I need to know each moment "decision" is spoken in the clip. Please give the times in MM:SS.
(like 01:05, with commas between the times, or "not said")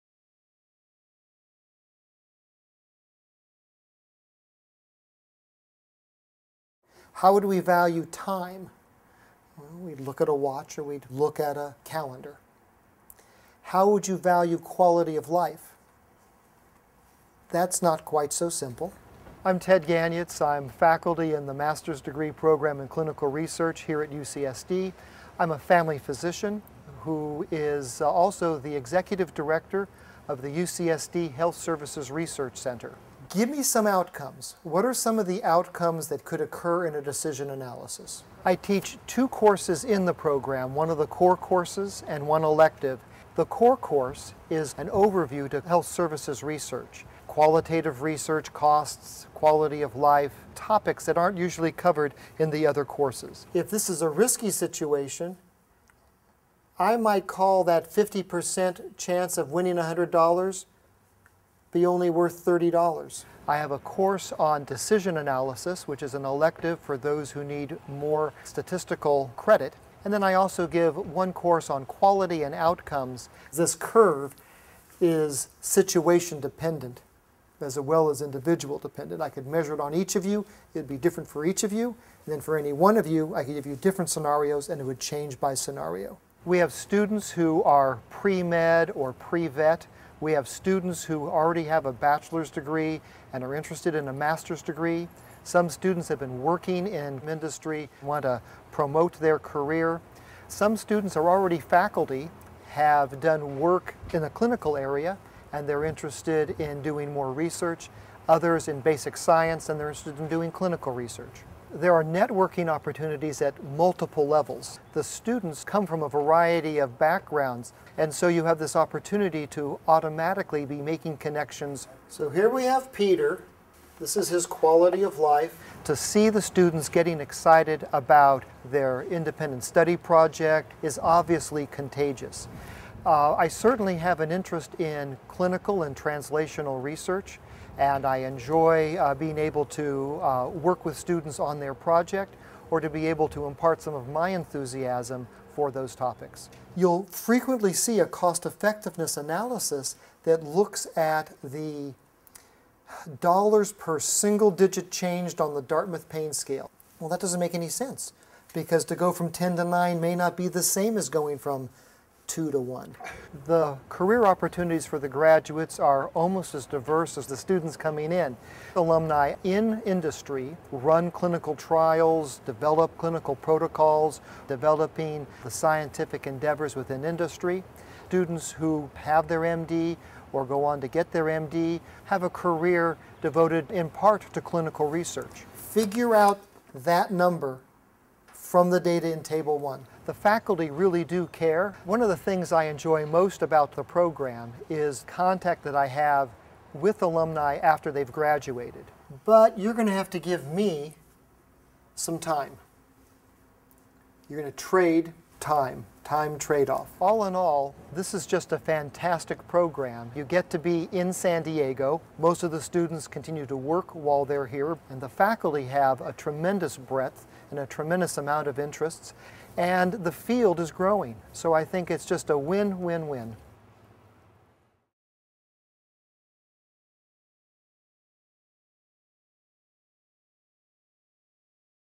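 00:37, 01:04.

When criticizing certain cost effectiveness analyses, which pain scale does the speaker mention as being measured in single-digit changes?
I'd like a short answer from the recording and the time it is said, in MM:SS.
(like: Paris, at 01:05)
Dartmouth pain scale, at 02:35.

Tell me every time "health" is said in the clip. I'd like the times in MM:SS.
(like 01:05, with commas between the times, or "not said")
00:31, 00:45.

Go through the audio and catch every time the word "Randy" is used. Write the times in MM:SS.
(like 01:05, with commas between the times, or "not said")
not said.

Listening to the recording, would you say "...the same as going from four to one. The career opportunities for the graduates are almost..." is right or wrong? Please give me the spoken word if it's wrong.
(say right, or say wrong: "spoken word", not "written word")
wrong: "two", not "four".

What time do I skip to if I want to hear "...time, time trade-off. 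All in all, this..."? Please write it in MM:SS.
03:25.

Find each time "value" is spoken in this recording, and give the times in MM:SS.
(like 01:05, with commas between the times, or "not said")
00:07, 00:14.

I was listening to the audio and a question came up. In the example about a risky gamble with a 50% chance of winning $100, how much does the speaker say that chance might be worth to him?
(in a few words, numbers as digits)
$30.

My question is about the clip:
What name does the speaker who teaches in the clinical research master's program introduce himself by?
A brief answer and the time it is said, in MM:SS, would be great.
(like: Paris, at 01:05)
Ted Ganiats, at 00:19.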